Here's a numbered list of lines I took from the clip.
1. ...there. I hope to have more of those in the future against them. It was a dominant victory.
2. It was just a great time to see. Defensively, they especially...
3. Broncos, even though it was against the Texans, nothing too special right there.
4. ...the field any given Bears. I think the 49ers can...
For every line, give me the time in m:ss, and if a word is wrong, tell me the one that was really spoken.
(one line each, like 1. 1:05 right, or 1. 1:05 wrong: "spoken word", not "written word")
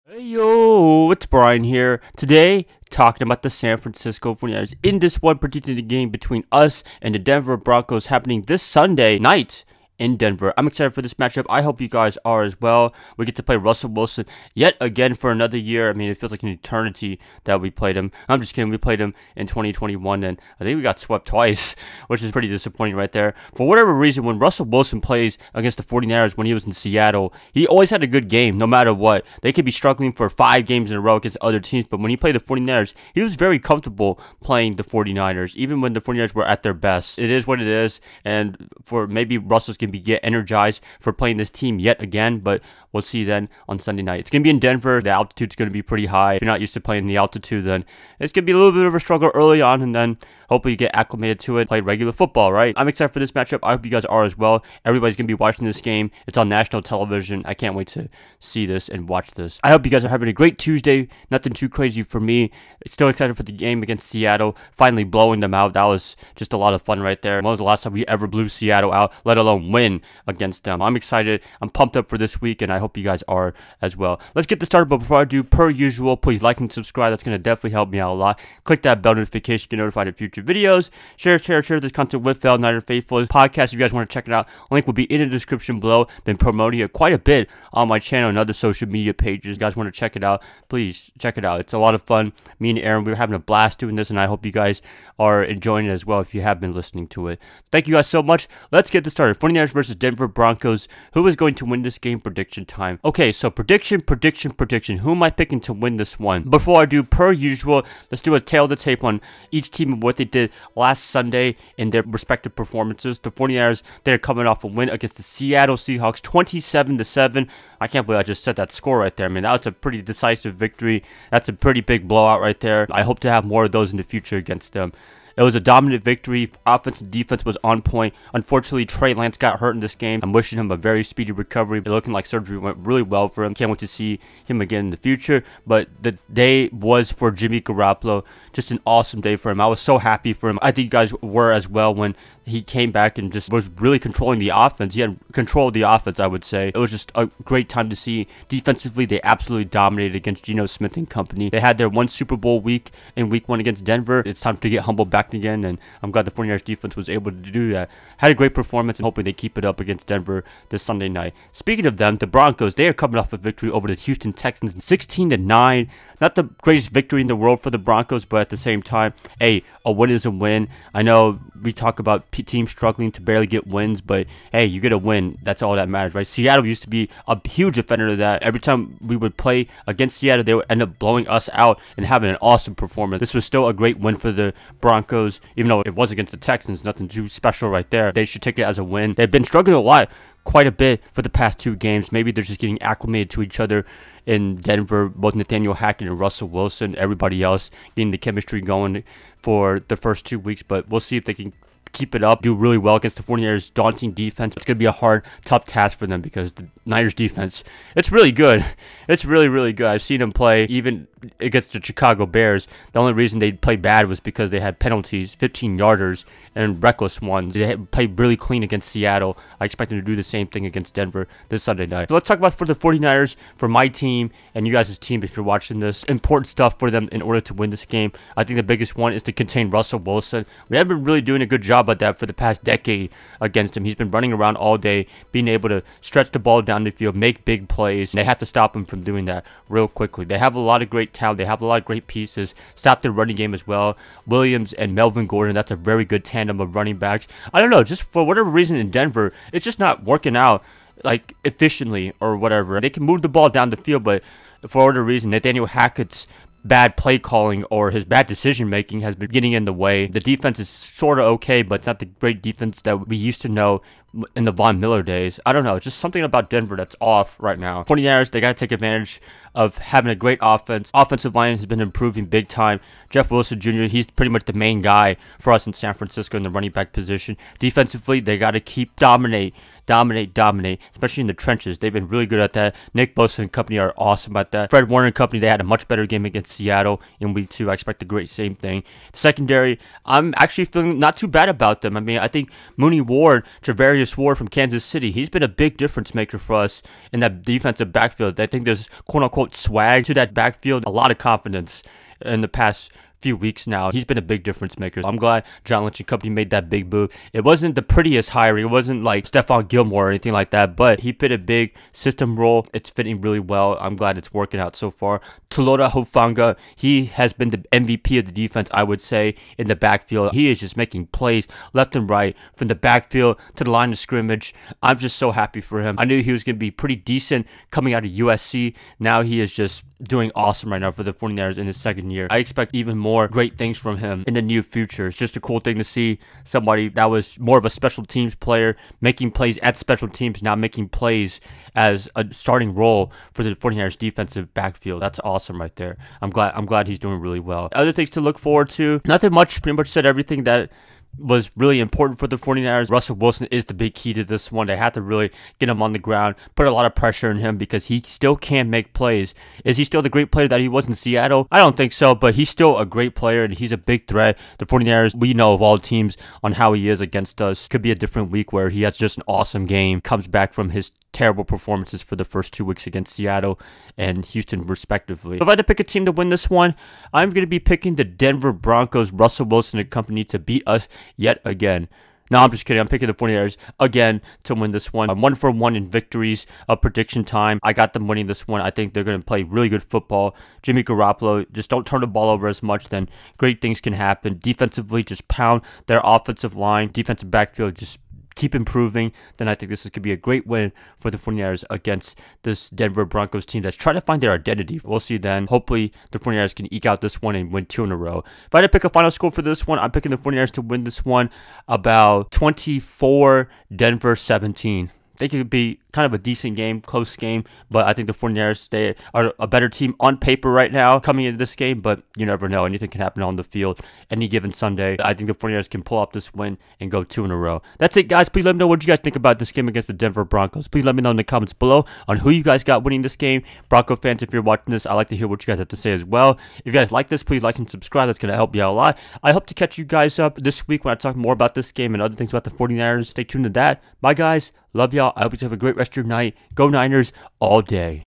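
1. 2:02 right
2. 2:26 wrong: "absolutely", not "especially"
3. 3:05 right
4. 7:03 wrong: "Sunday", not "Bears".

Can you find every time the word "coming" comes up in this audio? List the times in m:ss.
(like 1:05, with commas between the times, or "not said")
1:54, 2:42, 5:27, 7:00.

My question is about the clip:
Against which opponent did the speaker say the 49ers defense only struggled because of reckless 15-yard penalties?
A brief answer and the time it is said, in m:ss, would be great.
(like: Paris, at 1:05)
Chicago Bears, at 3:31.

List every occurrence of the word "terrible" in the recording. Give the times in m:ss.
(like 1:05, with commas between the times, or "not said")
6:11.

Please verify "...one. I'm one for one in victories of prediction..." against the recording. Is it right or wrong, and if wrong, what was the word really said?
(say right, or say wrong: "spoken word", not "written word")
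right.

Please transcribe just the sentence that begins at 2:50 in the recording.
I know we talk about teams struggling to barely get wins, but hey, you get a win.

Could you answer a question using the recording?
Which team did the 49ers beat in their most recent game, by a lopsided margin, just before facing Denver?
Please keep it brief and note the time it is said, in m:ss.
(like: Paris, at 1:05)
Seattle Seahawks, at 1:55.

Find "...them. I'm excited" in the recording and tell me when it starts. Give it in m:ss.
1:10.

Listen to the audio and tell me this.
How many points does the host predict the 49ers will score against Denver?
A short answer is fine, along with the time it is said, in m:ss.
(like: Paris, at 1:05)
24, at 6:52.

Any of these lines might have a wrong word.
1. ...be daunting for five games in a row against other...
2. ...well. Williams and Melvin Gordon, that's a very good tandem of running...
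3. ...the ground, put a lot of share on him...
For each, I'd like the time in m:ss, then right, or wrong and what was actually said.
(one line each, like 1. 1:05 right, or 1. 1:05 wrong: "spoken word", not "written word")
1. 0:29 wrong: "struggling", not "daunting"
2. 4:03 right
3. 5:55 wrong: "pressure", not "share".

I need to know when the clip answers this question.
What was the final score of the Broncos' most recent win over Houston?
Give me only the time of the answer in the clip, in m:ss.
2:44.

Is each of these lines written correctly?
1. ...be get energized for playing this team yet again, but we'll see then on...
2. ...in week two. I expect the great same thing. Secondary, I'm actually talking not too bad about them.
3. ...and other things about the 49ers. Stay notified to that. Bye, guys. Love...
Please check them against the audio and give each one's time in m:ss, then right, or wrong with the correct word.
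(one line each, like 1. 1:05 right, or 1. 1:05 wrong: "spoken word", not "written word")
1. 0:39 right
2. 4:47 wrong: "feeling", not "talking"
3. 7:21 wrong: "tuned", not "notified".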